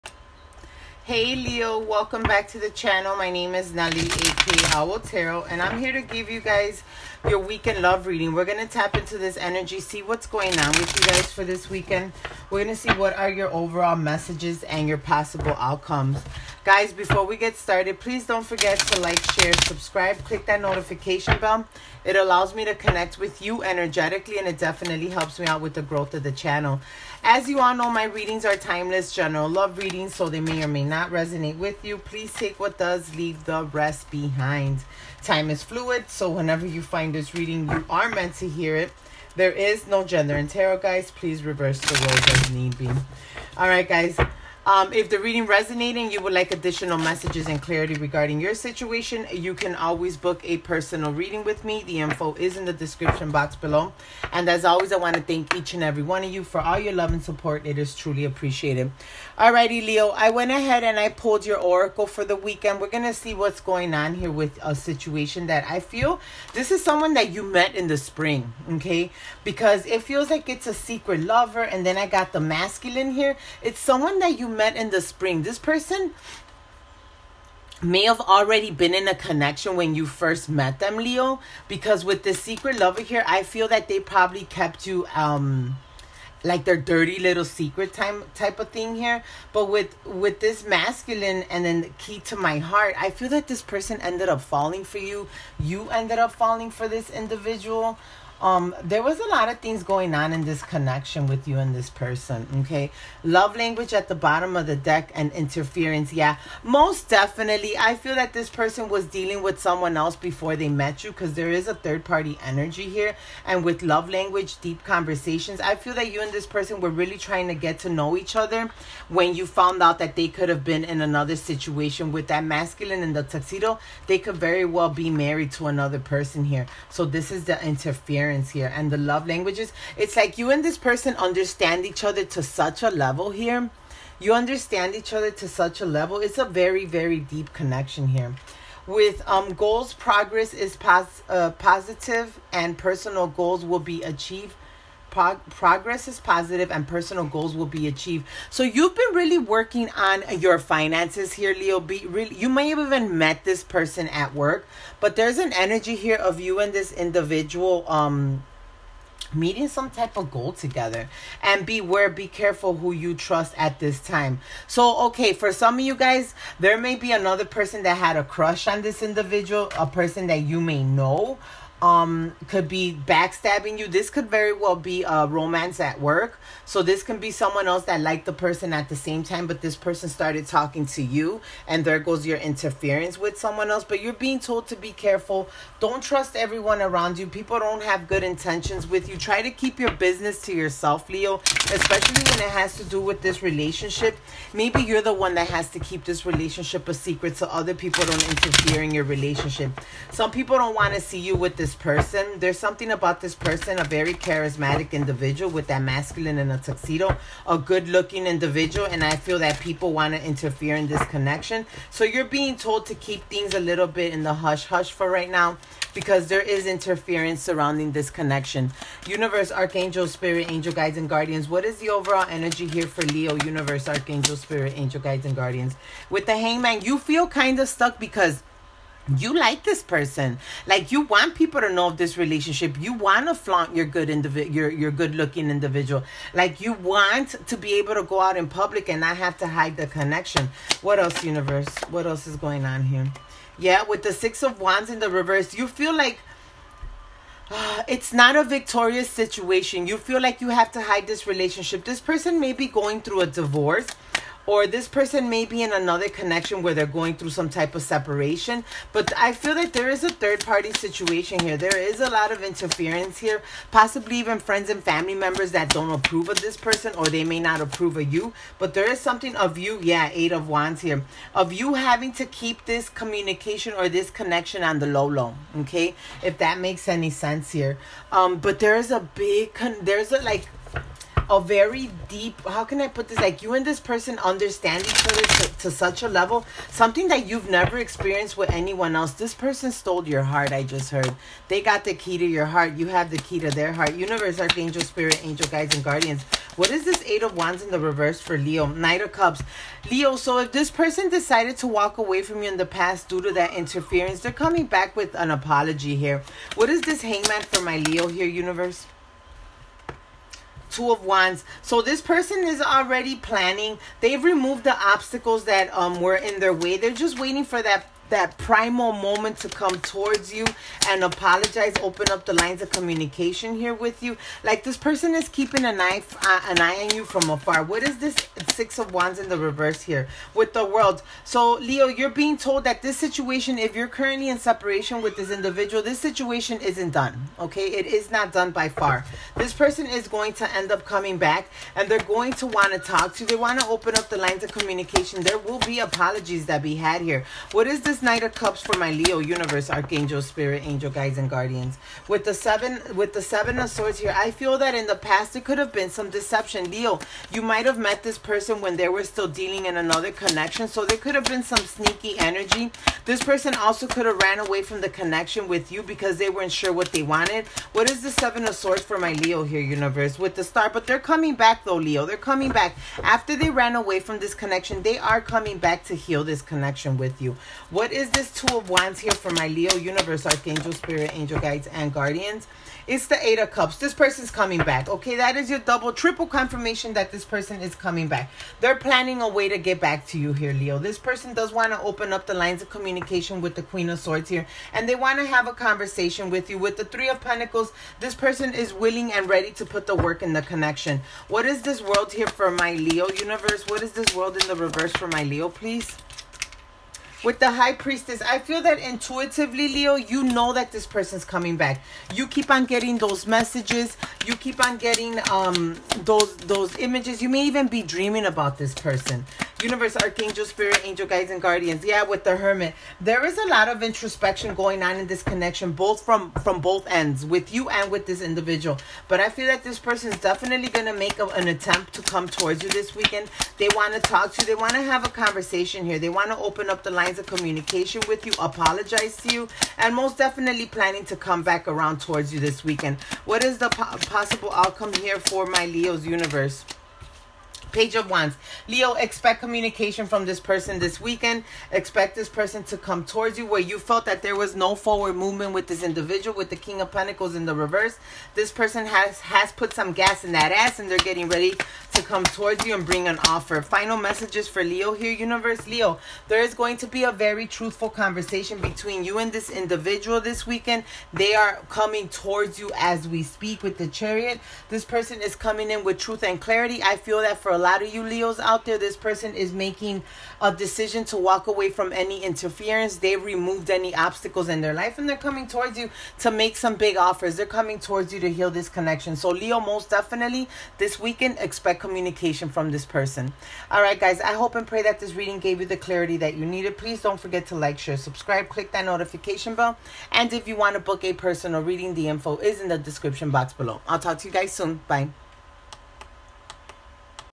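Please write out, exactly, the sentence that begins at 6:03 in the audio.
This person also could have ran away from the connection with you because they weren't sure what they wanted.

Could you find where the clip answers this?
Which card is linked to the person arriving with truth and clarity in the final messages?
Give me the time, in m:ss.
7:53.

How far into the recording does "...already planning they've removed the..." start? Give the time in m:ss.
5:12.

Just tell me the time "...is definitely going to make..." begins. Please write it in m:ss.
7:10.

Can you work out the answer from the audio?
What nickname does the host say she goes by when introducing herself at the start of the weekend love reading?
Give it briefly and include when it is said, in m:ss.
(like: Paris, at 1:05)
Owl Tarot, at 0:04.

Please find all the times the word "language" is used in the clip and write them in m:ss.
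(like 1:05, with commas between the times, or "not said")
1:43, 1:54, 2:09.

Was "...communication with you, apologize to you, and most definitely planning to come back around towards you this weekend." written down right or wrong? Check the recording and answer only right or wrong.
right.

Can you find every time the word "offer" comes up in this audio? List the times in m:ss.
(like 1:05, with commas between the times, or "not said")
7:43, 8:06.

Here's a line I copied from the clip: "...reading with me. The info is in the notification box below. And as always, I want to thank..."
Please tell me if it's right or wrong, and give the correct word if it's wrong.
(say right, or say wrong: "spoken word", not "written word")
wrong: "description", not "notification".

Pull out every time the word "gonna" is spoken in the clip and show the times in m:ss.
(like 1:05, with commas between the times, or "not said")
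0:08, 0:12.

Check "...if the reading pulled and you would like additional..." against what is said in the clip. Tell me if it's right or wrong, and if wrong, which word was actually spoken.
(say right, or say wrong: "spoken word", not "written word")
wrong: "resonated", not "pulled".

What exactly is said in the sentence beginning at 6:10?
With the star, but they're coming back though, Leo.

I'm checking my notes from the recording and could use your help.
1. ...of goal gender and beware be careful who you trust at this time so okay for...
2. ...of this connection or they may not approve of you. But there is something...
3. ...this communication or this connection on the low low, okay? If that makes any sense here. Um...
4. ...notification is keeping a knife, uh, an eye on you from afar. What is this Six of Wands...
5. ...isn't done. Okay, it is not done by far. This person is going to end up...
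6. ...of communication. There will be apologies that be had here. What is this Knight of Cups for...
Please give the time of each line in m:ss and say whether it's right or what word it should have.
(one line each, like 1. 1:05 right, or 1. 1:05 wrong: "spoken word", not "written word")
1. 2:40 wrong: "together", not "gender"
2. 4:26 wrong: "person", not "connection"
3. 4:32 right
4. 5:24 wrong: "person", not "notification"
5. 5:36 right
6. 5:44 right.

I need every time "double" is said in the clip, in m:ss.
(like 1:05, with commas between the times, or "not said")
6:25.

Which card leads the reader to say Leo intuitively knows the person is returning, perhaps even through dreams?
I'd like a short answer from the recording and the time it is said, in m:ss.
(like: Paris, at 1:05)
The High Priestess, at 6:47.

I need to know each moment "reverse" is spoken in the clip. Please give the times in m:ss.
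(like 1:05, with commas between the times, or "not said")
0:41, 4:05, 4:57, 5:29, 6:44, 7:37.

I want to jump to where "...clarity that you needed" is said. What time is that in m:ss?
8:15.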